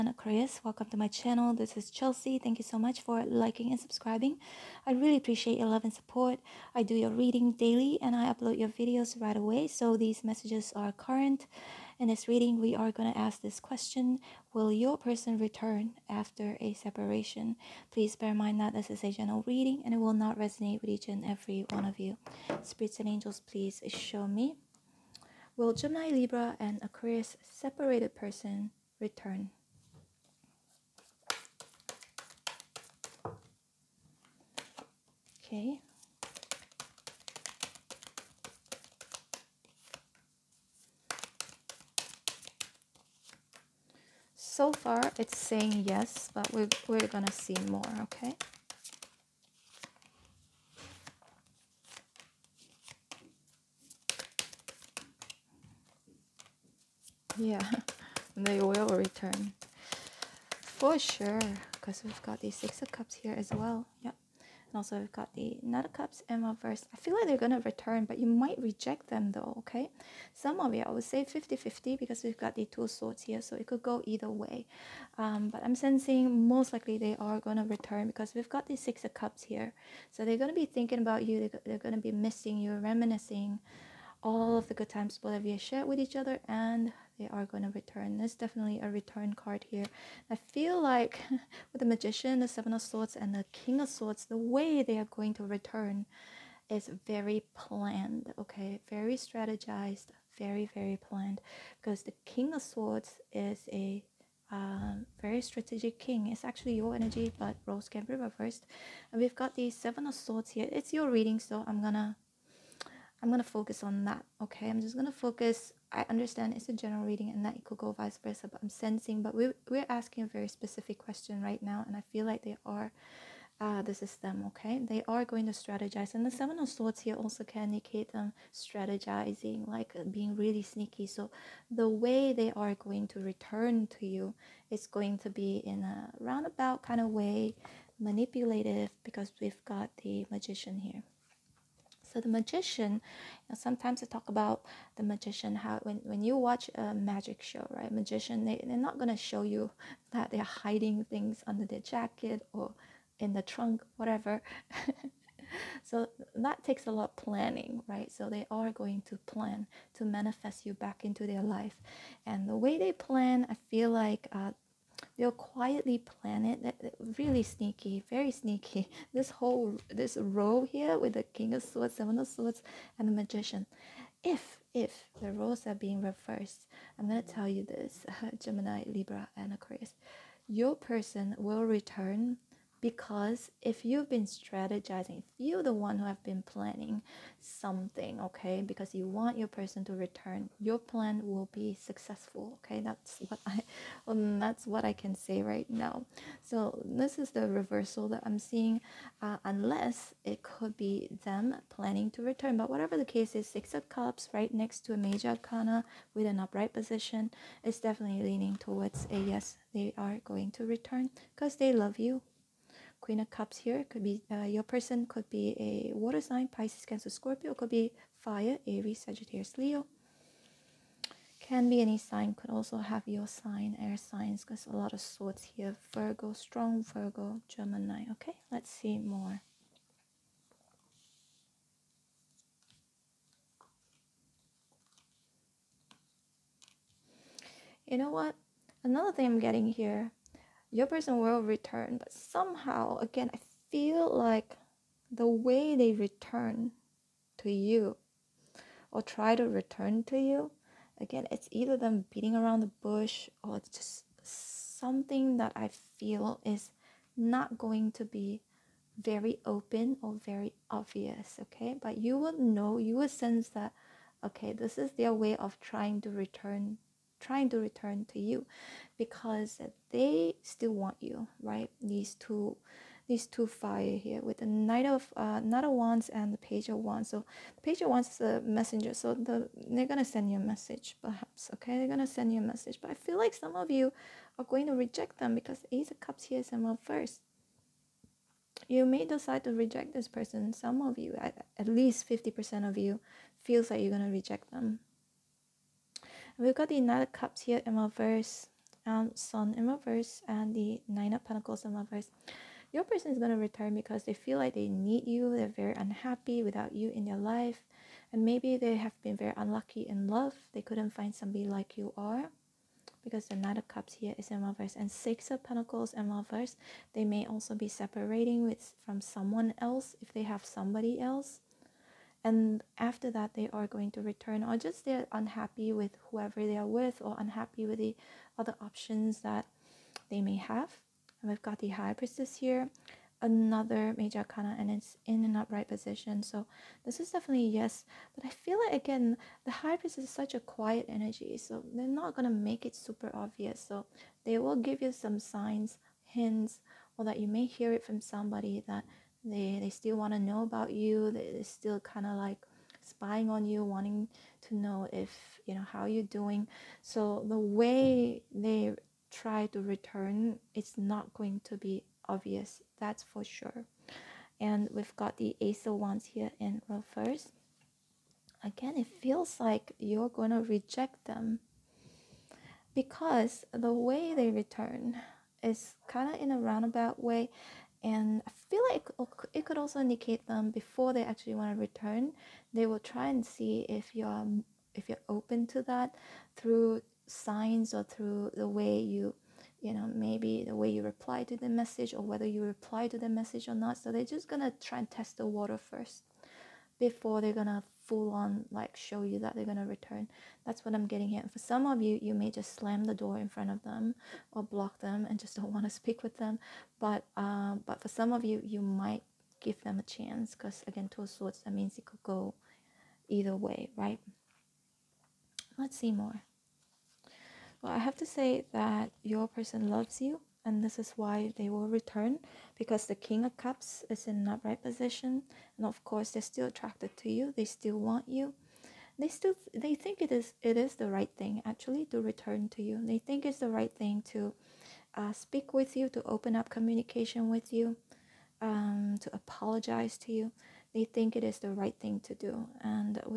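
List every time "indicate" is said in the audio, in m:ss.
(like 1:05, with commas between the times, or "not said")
2:07, 6:19.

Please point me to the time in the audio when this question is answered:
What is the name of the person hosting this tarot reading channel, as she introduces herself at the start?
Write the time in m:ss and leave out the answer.
0:01.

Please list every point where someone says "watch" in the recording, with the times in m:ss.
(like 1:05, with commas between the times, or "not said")
2:26.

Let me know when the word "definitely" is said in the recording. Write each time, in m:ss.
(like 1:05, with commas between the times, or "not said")
1:28, 3:27, 5:37.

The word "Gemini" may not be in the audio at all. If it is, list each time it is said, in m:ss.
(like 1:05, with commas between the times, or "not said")
0:25, 2:58, 3:47.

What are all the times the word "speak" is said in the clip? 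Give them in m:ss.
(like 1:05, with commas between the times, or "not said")
6:45, 7:15.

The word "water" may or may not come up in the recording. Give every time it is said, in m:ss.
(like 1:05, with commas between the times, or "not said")
3:35, 6:35.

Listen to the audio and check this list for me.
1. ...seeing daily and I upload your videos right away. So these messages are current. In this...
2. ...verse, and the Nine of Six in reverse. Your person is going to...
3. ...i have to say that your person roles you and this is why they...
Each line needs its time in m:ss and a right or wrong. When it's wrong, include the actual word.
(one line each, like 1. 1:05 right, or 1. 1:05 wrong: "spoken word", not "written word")
1. 0:07 wrong: "reading", not "seeing"
2. 4:59 wrong: "Pentacles", not "Six"
3. 6:57 wrong: "loves", not "roles".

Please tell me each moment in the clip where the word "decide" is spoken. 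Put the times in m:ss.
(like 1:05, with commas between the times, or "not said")
4:49.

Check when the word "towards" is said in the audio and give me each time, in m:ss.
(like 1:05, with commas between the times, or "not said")
3:28.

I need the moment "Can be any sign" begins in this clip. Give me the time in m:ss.
3:41.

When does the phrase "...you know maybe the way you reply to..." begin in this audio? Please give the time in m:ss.
6:29.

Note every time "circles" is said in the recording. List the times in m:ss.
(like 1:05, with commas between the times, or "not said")
not said.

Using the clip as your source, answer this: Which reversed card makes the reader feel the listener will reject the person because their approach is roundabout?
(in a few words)
Ace of Wands.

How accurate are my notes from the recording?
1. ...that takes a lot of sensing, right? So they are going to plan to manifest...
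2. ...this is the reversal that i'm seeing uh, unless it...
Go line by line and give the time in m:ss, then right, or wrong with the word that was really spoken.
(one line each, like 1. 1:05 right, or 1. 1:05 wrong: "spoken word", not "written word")
1. 2:36 wrong: "planning", not "sensing"
2. 3:16 right.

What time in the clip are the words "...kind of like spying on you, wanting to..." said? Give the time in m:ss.
5:51.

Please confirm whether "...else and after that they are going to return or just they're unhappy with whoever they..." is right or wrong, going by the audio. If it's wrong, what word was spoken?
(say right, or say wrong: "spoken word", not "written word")
right.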